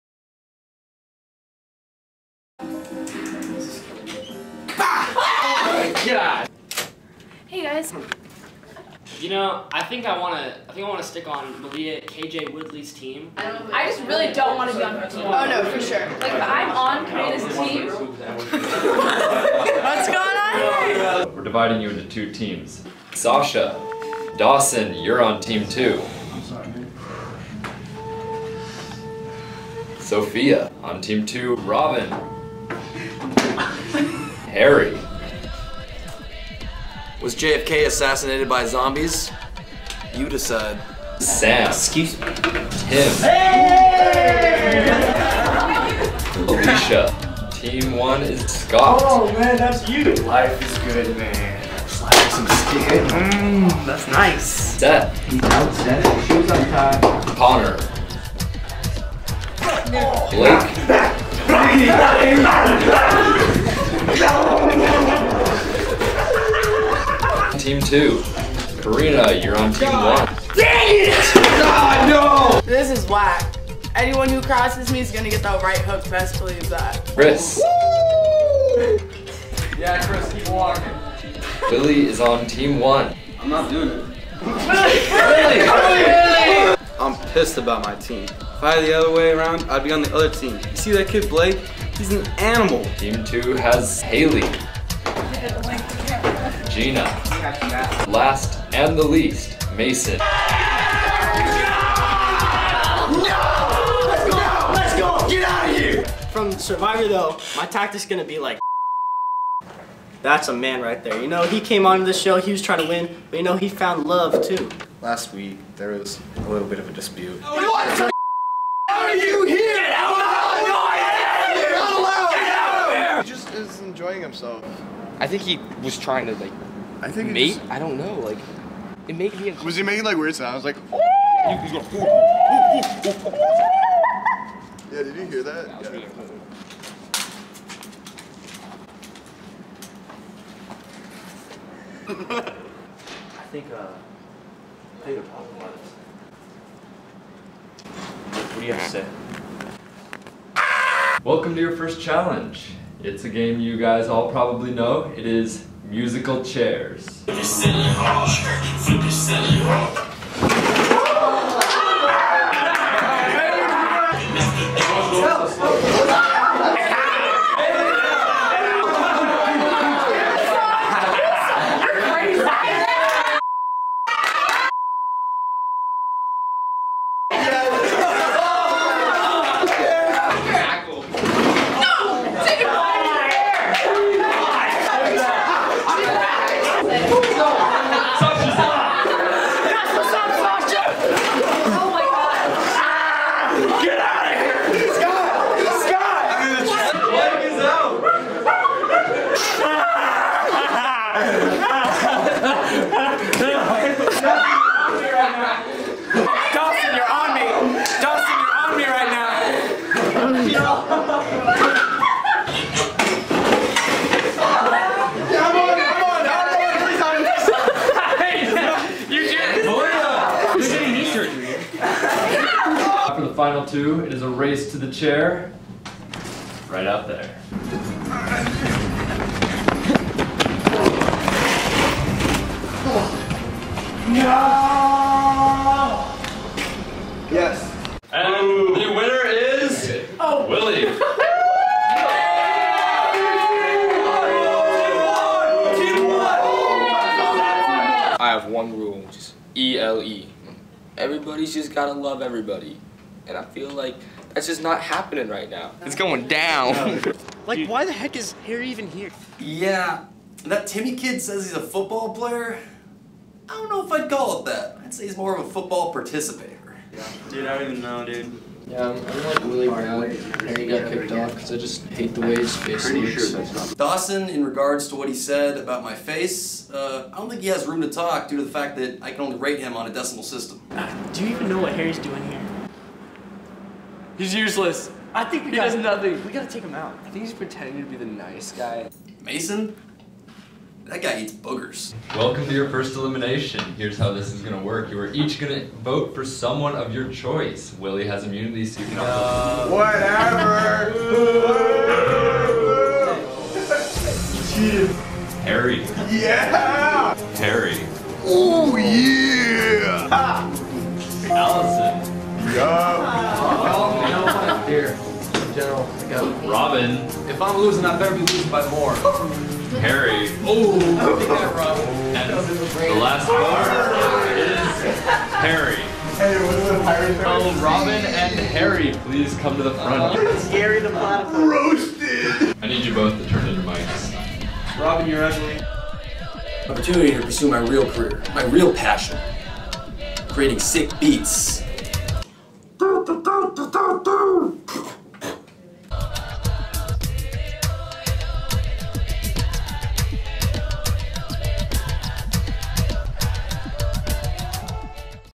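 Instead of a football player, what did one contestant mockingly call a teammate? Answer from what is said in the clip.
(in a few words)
Participator.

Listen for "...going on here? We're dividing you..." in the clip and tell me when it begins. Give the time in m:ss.
0:20.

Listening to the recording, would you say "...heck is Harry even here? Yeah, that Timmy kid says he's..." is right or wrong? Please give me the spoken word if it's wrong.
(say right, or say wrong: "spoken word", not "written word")
right.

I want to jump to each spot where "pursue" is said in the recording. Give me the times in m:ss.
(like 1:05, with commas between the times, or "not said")
5:37.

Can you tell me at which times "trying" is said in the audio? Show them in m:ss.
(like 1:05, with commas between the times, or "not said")
1:52, 2:05.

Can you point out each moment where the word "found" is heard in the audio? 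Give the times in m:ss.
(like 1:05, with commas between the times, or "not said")
1:53.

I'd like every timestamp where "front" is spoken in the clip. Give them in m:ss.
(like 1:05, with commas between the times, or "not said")
5:29.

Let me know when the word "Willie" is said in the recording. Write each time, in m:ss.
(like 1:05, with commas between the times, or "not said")
4:00, 4:57.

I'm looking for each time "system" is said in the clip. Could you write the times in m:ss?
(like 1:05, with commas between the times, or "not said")
4:40.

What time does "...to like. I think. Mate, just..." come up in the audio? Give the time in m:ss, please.
2:06.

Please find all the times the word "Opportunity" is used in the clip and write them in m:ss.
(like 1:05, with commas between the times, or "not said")
5:36.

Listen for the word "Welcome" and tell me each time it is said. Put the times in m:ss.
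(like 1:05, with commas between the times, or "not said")
2:31, 4:52.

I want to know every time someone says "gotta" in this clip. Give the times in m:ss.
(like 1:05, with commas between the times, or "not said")
4:11, 4:46.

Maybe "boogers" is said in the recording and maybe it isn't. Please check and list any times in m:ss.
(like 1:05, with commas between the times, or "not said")
4:51.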